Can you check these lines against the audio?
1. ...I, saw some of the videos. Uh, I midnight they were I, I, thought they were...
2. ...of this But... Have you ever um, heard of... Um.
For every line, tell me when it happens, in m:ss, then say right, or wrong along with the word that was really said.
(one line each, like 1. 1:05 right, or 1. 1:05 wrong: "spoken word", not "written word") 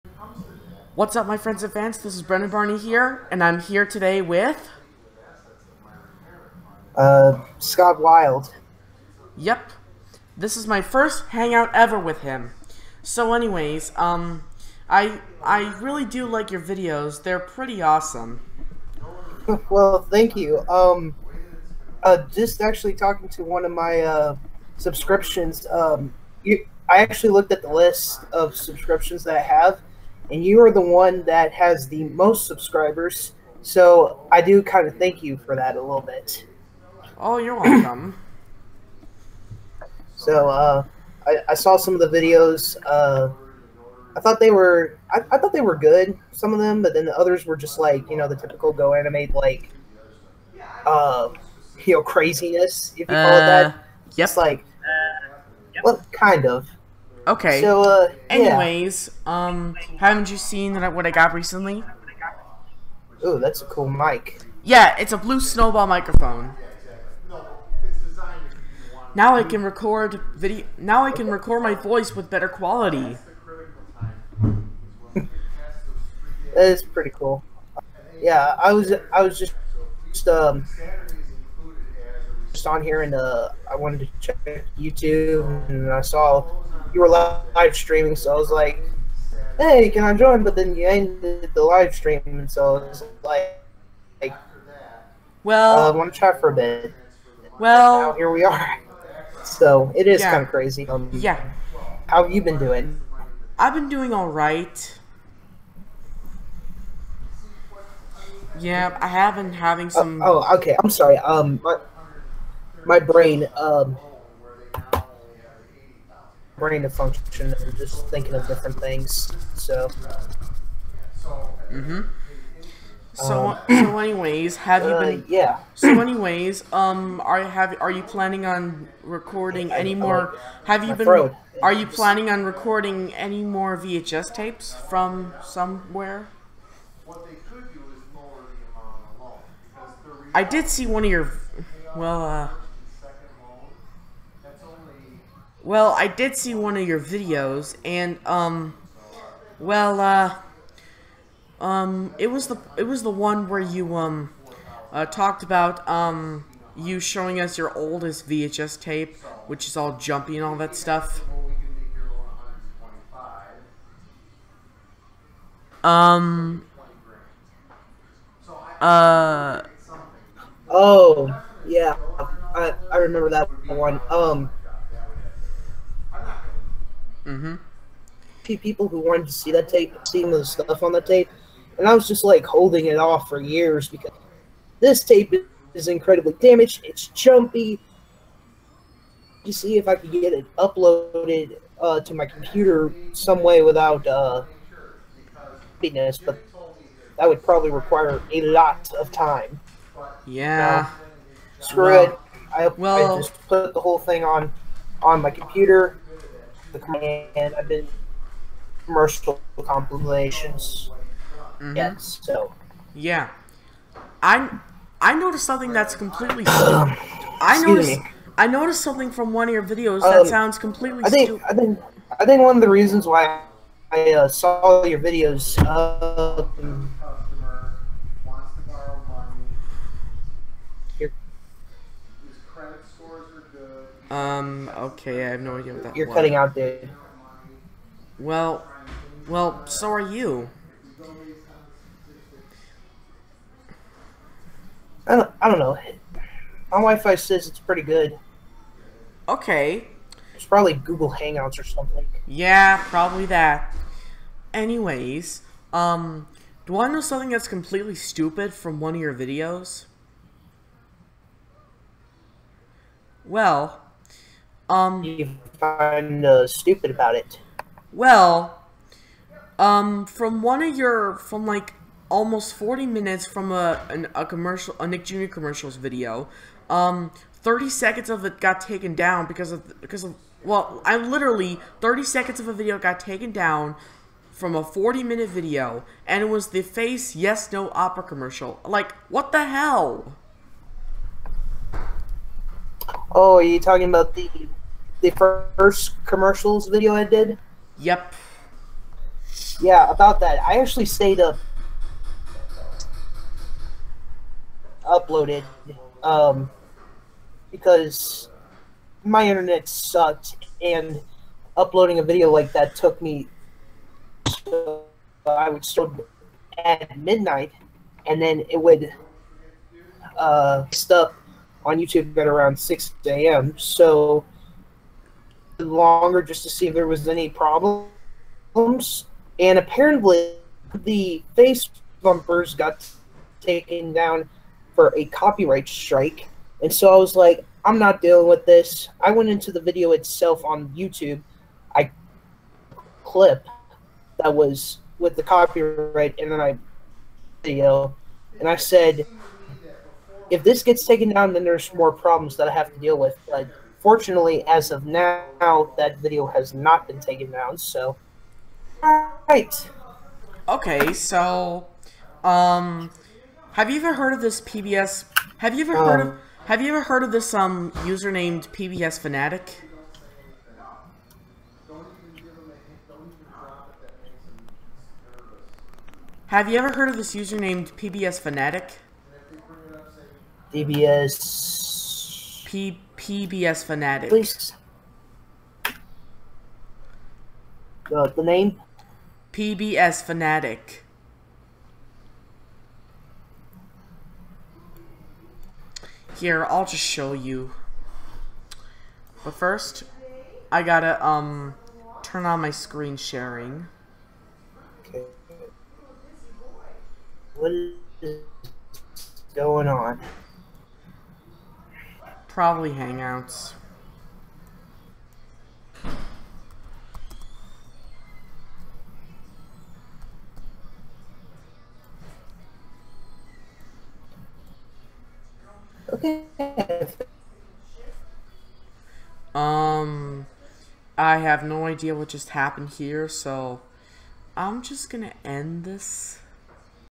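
1. 0:41 wrong: "thought", not "midnight"
2. 6:04 wrong: "PBS", not "But".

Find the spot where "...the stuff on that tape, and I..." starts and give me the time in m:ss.
3:00.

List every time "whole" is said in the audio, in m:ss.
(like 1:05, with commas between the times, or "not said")
3:23.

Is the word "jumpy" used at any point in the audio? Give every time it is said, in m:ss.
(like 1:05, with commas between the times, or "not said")
2:39, 3:07.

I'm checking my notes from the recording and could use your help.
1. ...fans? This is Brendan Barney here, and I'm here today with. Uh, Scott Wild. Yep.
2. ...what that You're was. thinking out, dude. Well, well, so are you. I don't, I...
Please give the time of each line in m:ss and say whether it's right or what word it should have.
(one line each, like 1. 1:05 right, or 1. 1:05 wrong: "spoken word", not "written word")
1. 0:01 right
2. 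3:55 wrong: "cutting", not "thinking".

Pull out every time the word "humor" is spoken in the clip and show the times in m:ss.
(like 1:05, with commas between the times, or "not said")
not said.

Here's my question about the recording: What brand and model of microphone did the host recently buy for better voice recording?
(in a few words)
Blue Snowball.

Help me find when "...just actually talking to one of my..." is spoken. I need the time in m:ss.
0:22.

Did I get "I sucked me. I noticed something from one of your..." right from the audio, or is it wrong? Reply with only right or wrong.
wrong.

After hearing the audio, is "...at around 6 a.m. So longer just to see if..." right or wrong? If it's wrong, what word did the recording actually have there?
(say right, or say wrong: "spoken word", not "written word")
right.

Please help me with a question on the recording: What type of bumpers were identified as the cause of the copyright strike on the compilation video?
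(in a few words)
Face bumpers.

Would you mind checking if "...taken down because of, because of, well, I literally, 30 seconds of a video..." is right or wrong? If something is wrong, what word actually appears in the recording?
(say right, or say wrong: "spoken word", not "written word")
right.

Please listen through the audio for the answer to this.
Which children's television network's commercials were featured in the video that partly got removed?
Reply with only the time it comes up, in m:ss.
4:34.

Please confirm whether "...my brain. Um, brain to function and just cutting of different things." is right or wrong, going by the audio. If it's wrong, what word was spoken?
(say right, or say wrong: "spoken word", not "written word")
wrong: "thinking", not "cutting".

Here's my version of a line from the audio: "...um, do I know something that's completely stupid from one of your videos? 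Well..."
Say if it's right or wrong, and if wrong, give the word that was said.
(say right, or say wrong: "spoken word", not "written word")
right.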